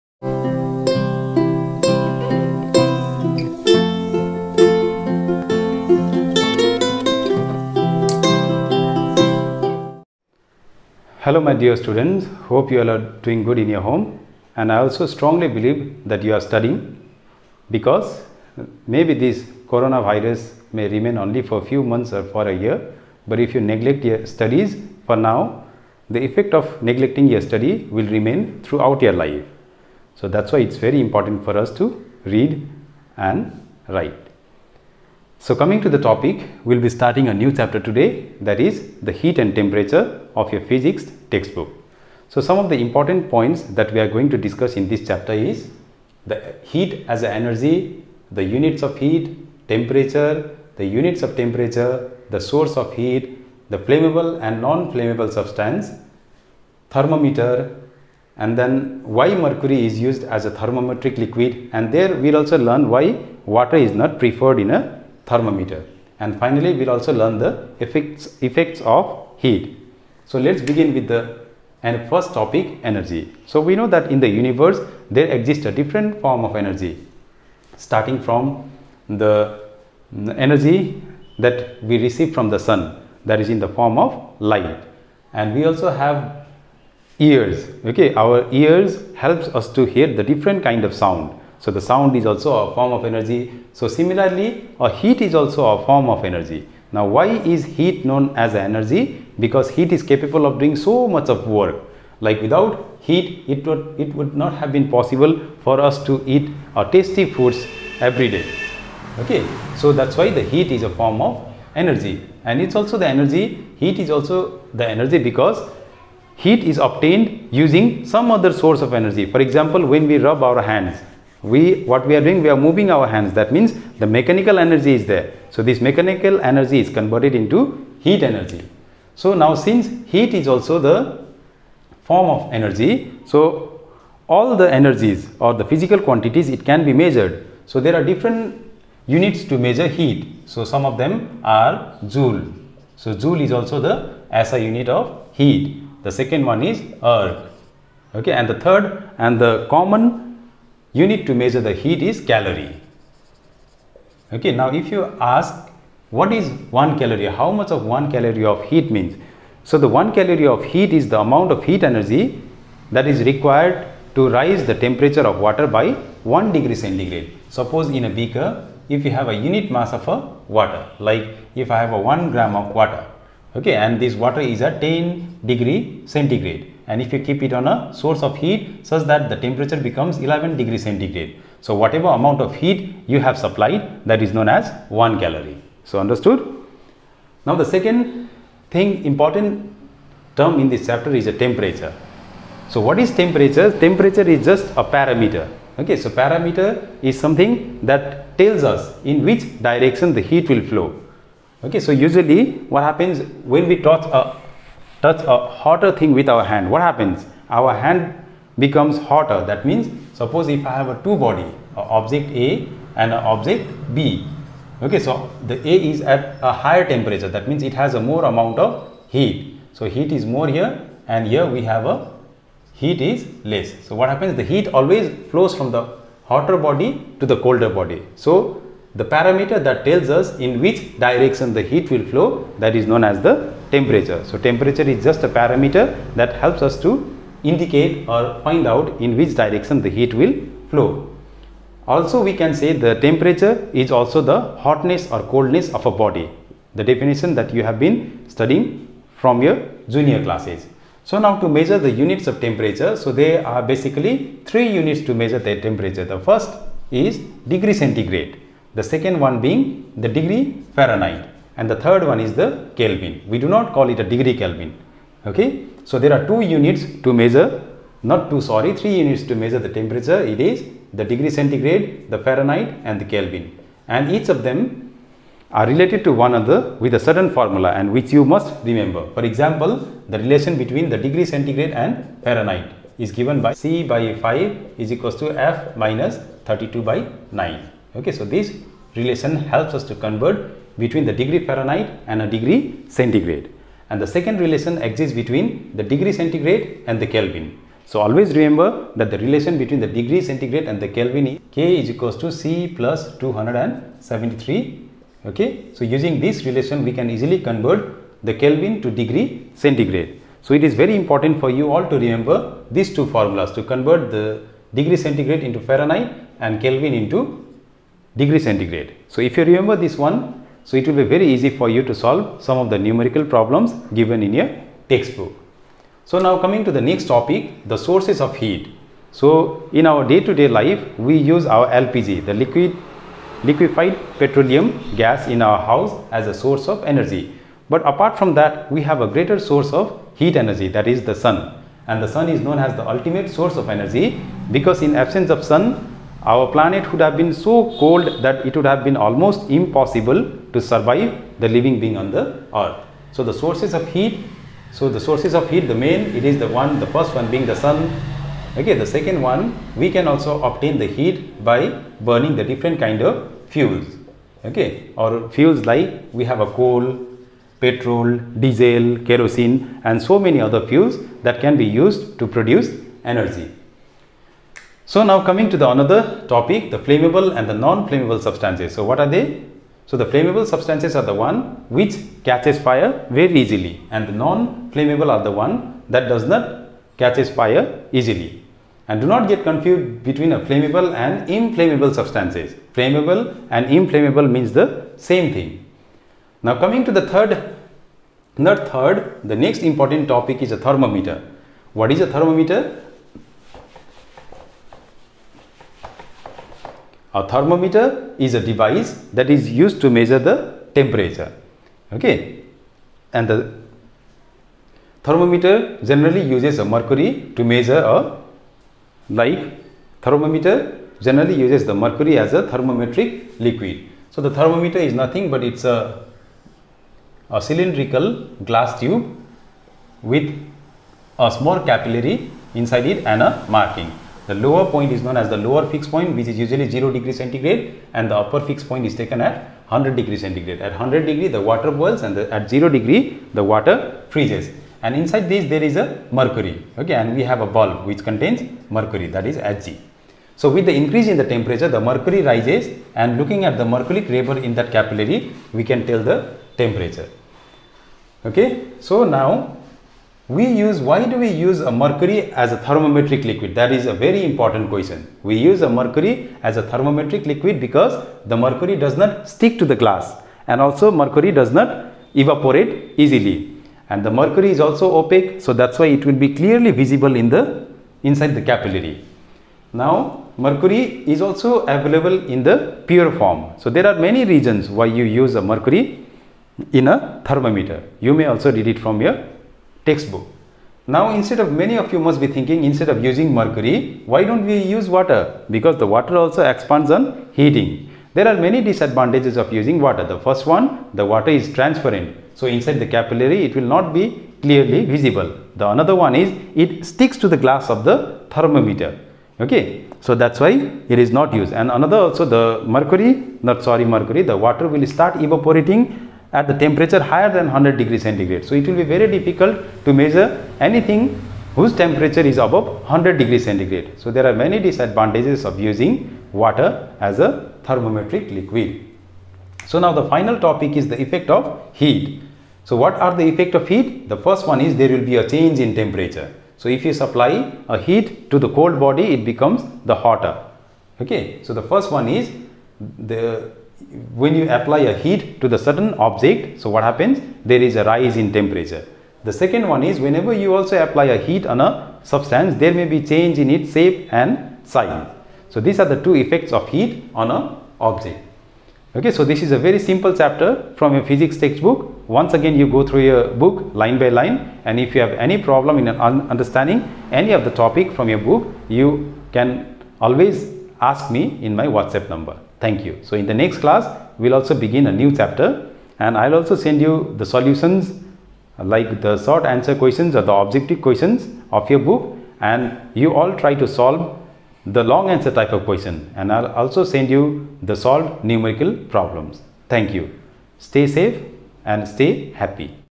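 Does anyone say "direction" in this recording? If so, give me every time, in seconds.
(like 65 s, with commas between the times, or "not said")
199 s, 230 s, 239 s.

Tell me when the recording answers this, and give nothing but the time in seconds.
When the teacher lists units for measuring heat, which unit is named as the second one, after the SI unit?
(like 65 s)
147 s.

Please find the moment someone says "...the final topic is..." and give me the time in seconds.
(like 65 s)
529 s.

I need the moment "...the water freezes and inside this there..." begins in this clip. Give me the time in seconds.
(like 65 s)
443 s.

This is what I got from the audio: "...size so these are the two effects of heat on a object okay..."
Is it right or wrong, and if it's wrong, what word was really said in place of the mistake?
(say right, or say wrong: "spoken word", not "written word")
right.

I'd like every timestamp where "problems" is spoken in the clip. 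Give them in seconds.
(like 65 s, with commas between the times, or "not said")
323 s, 565 s, 588 s.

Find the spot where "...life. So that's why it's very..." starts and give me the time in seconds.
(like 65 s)
29 s.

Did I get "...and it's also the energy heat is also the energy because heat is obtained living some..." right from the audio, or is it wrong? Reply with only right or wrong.
wrong.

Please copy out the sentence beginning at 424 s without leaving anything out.
So the thermometer is nothing but it's a, a cylindrical glass tube with a small capillary inside it and a marking.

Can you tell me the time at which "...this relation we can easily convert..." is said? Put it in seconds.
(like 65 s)
306 s.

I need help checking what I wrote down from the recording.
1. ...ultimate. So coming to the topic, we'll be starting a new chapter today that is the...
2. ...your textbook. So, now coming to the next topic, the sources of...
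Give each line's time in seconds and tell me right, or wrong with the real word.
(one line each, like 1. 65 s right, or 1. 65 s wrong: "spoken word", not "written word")
1. 33 s wrong: "write", not "ultimate"
2. 324 s right.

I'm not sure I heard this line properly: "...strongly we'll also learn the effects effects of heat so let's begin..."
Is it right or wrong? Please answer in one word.
wrong.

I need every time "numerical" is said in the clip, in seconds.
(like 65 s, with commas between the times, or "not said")
322 s, 588 s.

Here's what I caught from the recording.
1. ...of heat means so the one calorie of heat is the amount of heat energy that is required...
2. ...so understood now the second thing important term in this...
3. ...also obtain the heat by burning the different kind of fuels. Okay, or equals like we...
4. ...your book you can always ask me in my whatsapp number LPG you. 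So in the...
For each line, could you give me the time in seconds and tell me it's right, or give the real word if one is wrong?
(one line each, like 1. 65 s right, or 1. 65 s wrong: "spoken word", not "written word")
1. 158 s right
2. 185 s right
3. 360 s wrong: "fuels", not "equals"
4. 568 s wrong: "Thank", not "LPG".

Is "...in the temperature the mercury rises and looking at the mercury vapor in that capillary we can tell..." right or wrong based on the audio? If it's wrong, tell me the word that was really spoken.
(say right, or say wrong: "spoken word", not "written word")
right.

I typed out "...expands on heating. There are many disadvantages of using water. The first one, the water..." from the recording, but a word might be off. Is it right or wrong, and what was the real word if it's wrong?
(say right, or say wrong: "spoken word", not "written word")
right.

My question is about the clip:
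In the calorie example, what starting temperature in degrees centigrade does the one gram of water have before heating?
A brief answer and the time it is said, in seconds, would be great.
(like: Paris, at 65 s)
10, at 174 s.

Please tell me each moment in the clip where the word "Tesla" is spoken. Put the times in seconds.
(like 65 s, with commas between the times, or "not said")
not said.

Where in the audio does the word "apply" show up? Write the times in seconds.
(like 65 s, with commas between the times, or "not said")
544 s, 550 s.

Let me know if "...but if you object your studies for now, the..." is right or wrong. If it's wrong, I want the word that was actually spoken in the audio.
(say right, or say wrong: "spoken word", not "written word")
wrong: "neglect", not "object".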